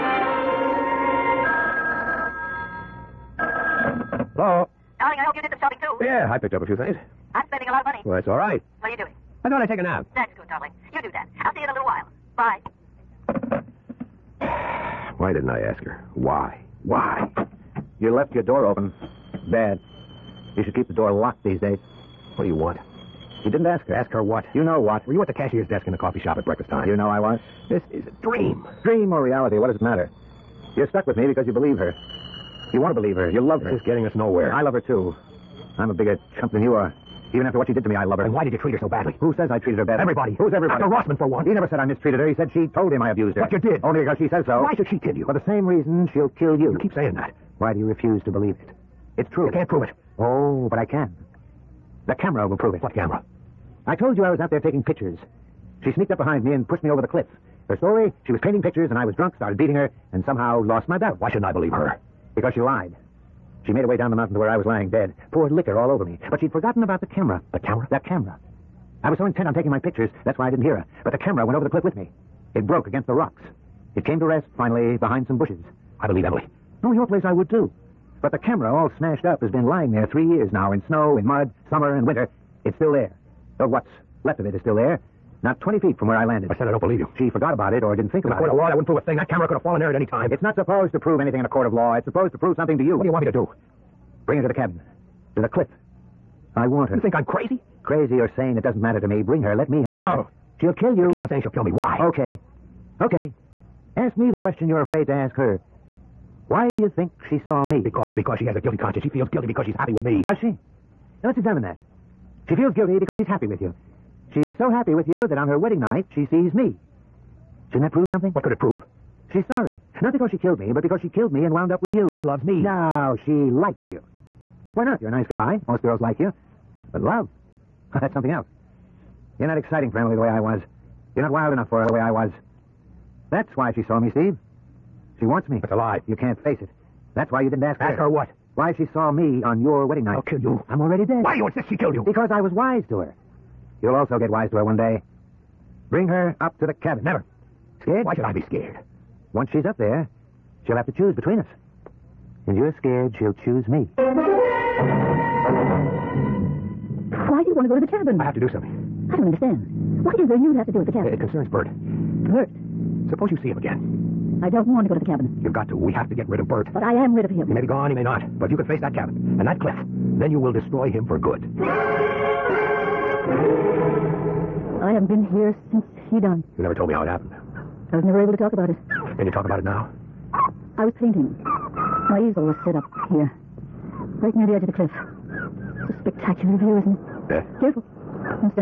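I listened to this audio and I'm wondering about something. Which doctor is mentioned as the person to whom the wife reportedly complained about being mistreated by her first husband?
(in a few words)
Dr. Rossman.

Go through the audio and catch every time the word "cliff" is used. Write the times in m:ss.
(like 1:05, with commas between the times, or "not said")
0:57, 1:11, 1:35, 2:49, 3:04.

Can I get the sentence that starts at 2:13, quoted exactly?
That's why she saw me, Steve.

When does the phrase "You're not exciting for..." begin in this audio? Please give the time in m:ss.
2:09.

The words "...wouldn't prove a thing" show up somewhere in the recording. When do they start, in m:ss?
1:28.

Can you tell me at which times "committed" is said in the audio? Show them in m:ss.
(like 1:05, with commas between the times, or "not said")
not said.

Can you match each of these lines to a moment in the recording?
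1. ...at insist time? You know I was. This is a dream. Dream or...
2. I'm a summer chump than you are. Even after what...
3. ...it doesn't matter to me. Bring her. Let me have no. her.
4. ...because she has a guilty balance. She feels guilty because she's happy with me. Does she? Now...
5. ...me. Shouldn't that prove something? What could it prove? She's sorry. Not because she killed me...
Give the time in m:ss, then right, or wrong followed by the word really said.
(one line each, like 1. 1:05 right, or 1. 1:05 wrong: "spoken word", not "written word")
1. 0:26 wrong: "breakfast", not "insist"
2. 0:35 wrong: "bigger", not "summer"
3. 1:38 right
4. 1:48 wrong: "conscience", not "balance"
5. 1:56 right.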